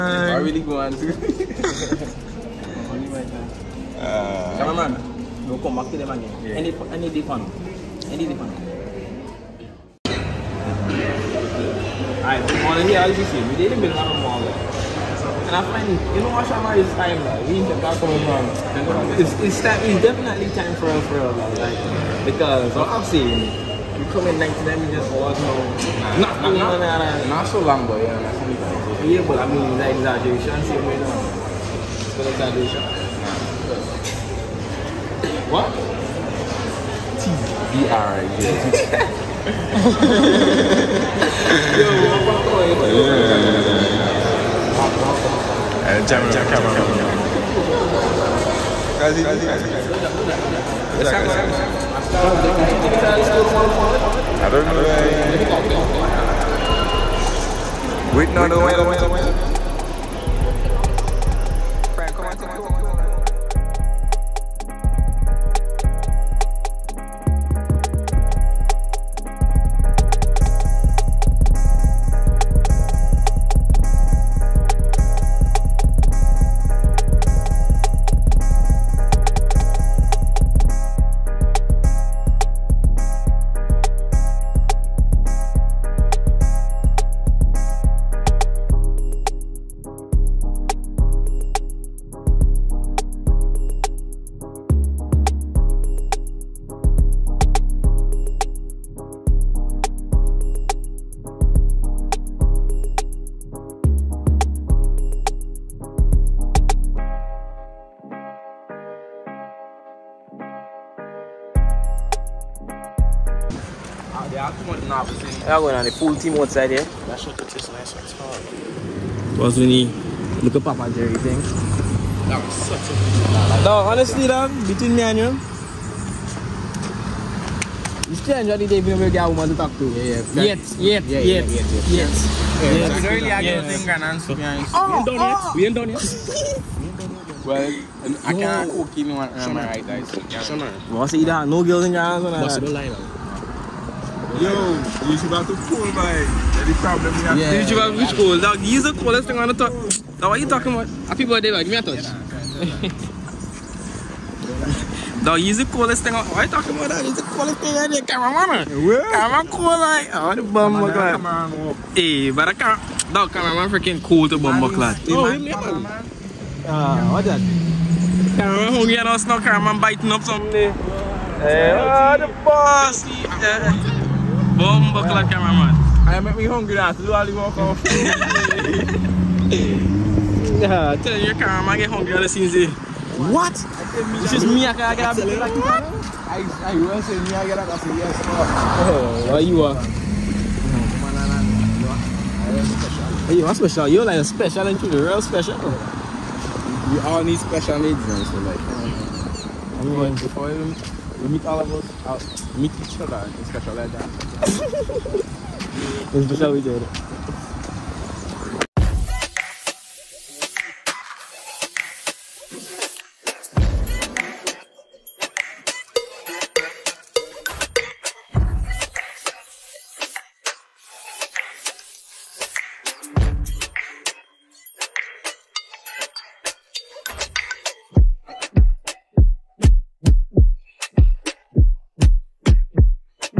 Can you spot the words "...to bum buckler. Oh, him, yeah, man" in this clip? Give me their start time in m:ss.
2:44.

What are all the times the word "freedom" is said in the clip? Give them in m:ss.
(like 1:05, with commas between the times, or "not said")
not said.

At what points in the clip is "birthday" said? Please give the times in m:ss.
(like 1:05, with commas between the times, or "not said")
2:31.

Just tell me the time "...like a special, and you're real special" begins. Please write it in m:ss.
3:14.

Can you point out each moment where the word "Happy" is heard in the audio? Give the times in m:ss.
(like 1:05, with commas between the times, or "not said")
2:31.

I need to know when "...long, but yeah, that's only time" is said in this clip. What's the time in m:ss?
0:27.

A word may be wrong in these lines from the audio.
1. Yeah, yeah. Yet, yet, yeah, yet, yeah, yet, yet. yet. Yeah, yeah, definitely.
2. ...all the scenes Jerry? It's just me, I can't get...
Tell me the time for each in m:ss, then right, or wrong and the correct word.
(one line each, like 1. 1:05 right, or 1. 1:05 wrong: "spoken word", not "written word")
1. 2:09 wrong: "exactly", not "definitely"
2. 3:02 wrong: "What", not "Jerry".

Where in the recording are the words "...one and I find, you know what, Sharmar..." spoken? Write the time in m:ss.
0:13.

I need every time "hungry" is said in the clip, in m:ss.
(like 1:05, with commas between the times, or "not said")
2:48, 2:56, 3:01.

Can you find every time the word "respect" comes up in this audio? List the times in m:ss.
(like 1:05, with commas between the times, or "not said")
not said.